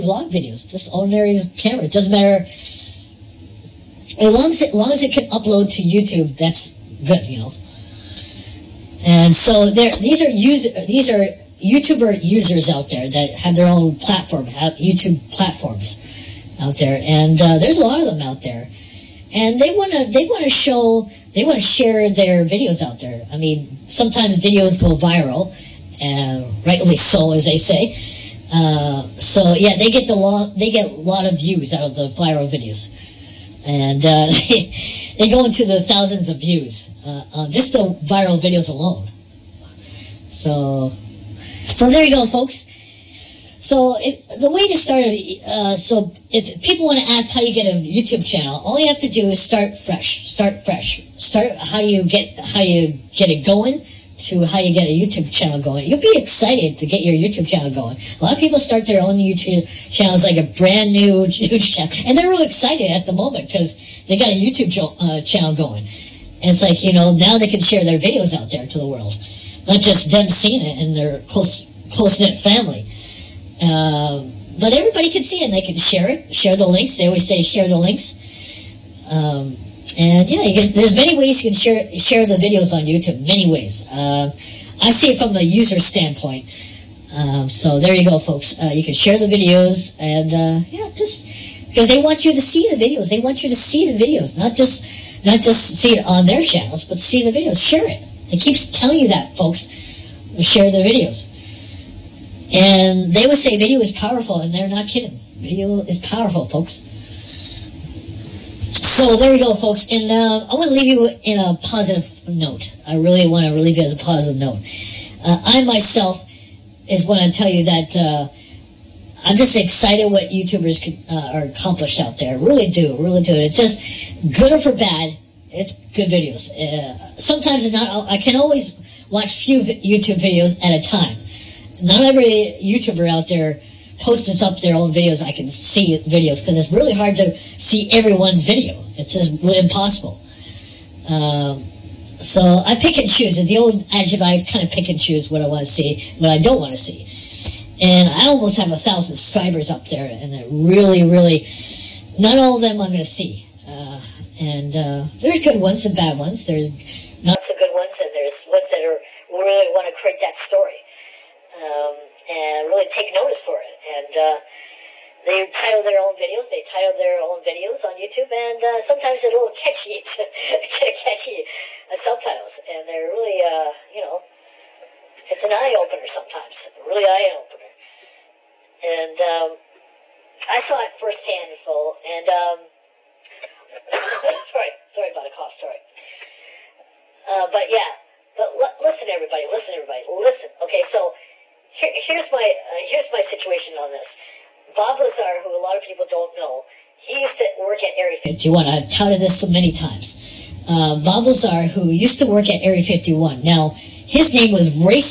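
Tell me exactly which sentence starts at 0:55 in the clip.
You'll be excited to get your YouTube channel going.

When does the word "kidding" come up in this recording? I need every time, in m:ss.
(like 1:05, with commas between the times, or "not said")
1:44.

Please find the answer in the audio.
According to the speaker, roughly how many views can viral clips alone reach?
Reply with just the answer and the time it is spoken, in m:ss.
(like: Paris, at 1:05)
thousands, at 0:35.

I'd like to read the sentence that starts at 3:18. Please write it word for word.
I've touted this so many times.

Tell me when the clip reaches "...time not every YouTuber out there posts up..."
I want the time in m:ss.
2:10.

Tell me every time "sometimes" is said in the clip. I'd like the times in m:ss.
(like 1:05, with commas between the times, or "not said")
0:23, 2:07, 2:48, 2:56.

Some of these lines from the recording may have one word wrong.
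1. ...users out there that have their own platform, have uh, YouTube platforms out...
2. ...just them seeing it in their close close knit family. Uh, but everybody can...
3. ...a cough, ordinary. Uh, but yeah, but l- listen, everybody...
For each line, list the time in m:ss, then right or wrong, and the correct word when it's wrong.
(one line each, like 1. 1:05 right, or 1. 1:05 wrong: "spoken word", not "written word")
1. 0:12 right
2. 1:09 right
3. 3:05 wrong: "sorry", not "ordinary".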